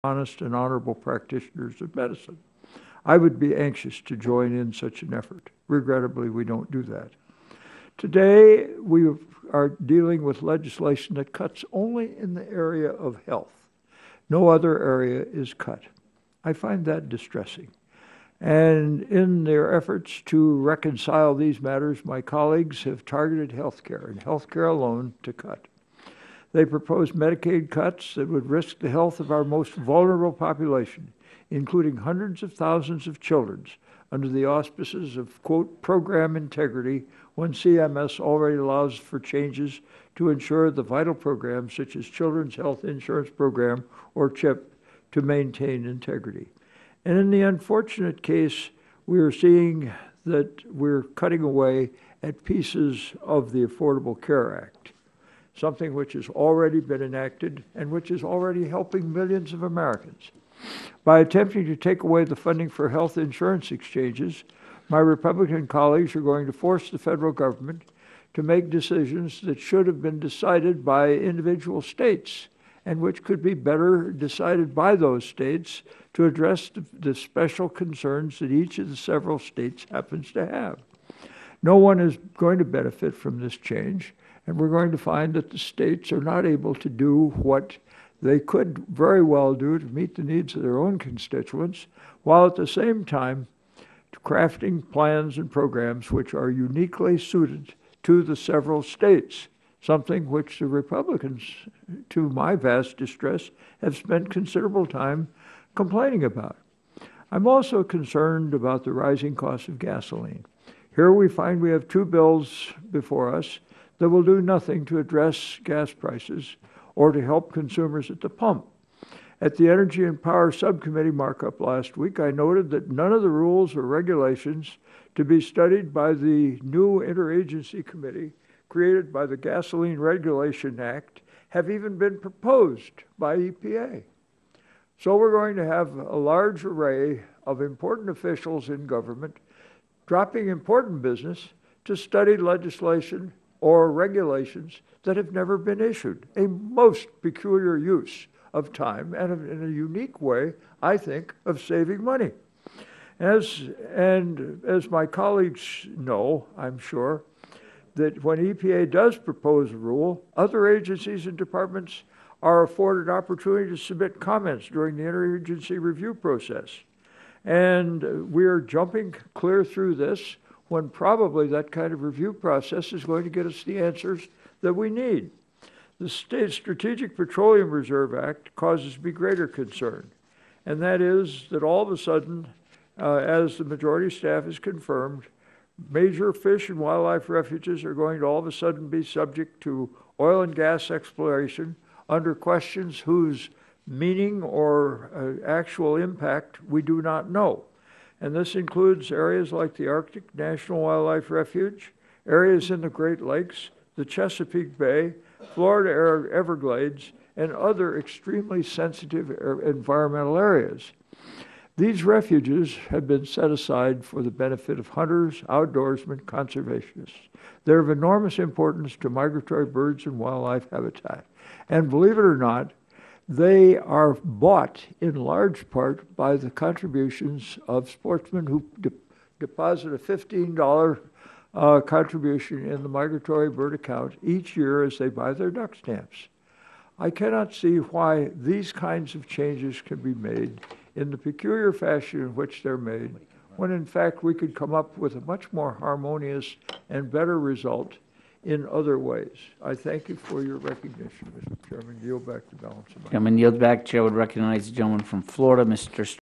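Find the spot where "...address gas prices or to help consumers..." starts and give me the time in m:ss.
1:54.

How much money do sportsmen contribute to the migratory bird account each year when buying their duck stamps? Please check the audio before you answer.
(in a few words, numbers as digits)
$15.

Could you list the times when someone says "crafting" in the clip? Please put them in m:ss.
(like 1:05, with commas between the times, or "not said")
1:34.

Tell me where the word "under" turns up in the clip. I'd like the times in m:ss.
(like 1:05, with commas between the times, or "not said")
0:34, 3:12.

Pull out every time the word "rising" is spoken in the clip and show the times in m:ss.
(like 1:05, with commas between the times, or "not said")
1:48.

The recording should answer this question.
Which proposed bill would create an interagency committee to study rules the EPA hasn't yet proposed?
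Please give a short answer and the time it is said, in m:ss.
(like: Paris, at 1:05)
Gasoline Regulation Act, at 2:09.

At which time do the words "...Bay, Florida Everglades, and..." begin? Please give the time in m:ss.
3:24.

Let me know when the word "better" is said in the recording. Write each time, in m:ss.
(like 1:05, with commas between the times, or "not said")
1:13, 4:07.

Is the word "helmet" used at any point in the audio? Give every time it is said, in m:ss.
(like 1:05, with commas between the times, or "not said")
not said.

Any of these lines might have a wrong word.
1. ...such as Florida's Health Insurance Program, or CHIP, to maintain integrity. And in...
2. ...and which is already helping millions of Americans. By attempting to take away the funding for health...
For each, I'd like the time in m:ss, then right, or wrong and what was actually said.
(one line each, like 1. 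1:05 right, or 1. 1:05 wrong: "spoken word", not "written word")
1. 0:41 wrong: "Children", not "Florida"
2. 0:57 right.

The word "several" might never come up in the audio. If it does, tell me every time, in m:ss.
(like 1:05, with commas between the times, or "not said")
1:18, 1:38.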